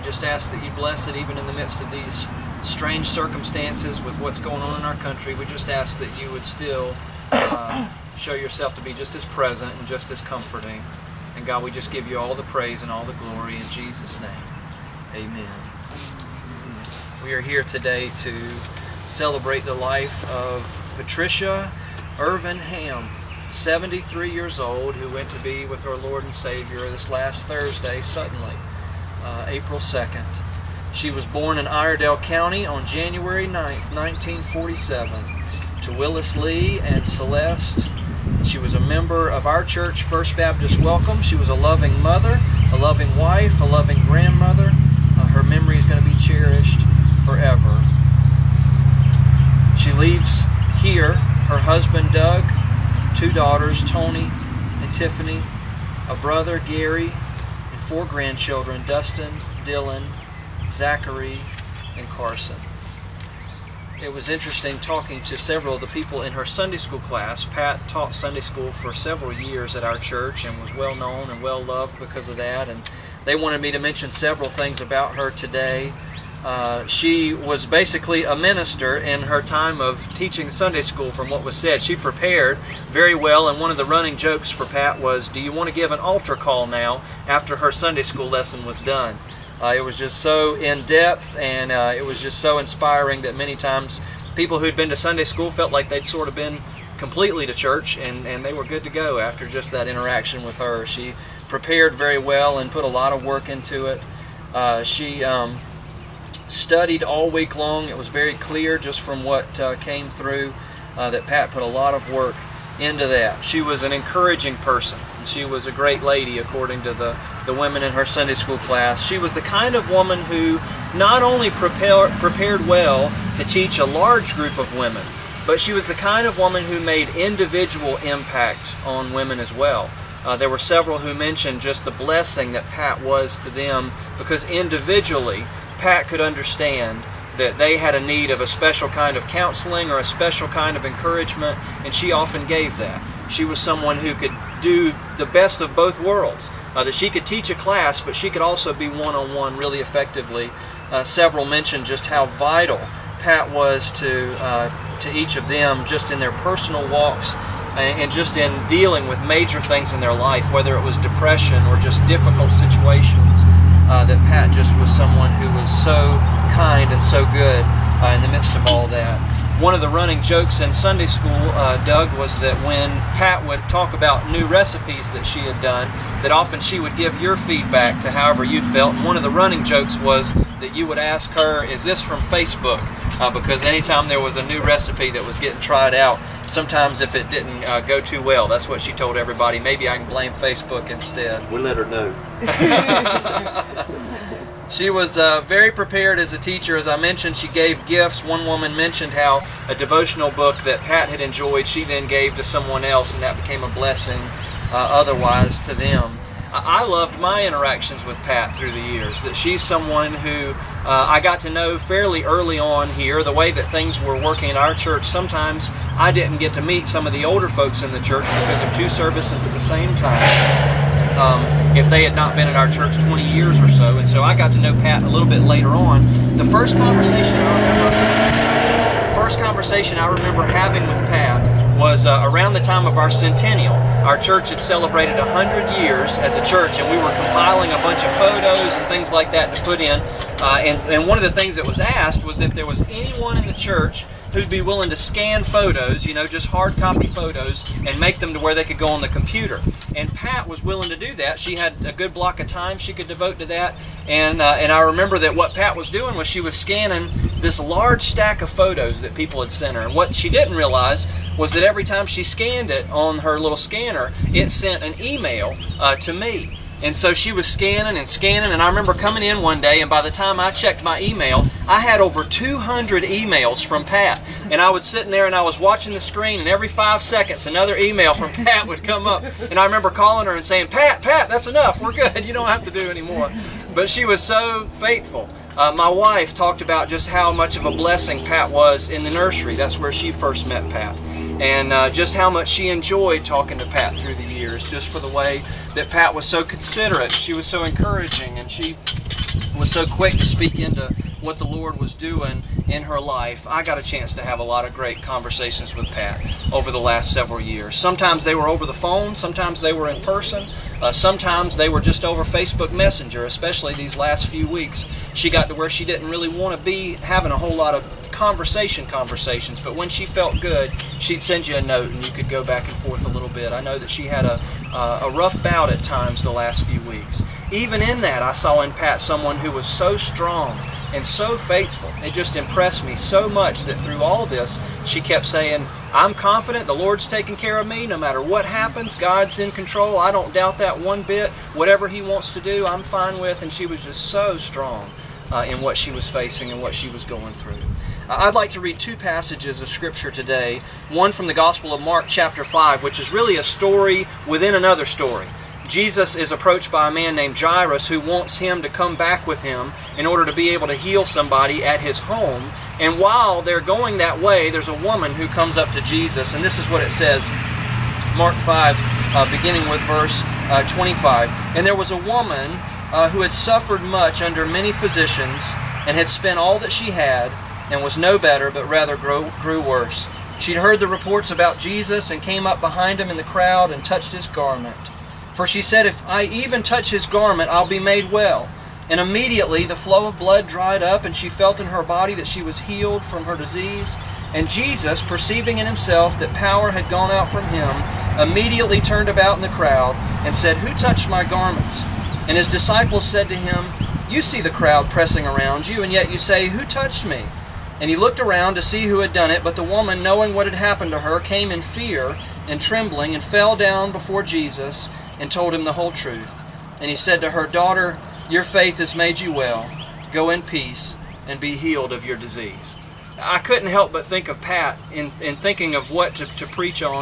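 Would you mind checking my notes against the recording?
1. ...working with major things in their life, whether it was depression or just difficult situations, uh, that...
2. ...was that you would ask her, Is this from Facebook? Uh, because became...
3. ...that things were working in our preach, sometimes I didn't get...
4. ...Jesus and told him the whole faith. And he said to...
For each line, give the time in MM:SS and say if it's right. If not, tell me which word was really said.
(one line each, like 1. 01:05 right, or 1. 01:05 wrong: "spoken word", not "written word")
1. 02:38 wrong: "dealing", not "working"
2. 02:59 wrong: "anytime", not "became"
3. 03:33 wrong: "church", not "preach"
4. 06:54 wrong: "truth", not "faith".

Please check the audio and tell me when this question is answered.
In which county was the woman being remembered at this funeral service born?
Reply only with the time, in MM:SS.
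00:31.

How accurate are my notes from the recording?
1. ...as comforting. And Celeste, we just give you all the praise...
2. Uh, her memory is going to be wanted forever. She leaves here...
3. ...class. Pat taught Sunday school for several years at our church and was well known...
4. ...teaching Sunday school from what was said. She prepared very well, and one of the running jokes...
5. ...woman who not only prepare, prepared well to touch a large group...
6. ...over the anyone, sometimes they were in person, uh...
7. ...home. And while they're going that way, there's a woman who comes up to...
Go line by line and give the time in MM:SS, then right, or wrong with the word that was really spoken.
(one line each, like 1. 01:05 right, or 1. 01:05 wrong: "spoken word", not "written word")
1. 00:10 wrong: "God", not "Celeste"
2. 00:45 wrong: "cherished", not "wanted"
3. 01:07 right
4. 01:20 right
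5. 01:59 wrong: "teach", not "touch"
6. 05:08 wrong: "phone", not "anyone"
7. 06:02 right.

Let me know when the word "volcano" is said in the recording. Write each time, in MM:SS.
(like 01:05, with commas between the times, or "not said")
not said.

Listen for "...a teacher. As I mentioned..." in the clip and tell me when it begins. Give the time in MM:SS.
03:16.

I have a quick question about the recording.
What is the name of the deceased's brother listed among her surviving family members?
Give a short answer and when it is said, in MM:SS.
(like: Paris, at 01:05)
Gary, at 00:56.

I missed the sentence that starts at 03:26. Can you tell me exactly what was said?
I loved my interactions with Pat through the years.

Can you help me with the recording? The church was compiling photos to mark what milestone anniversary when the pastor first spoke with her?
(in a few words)
100 years.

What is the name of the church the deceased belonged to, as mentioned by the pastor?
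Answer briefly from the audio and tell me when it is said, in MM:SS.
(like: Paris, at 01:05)
First Baptist Welcome, at 00:40.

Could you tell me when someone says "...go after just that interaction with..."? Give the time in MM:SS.
01:38.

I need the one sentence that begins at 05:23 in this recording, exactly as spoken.
I know that she had a, uh, a rough bout at times the last few weeks.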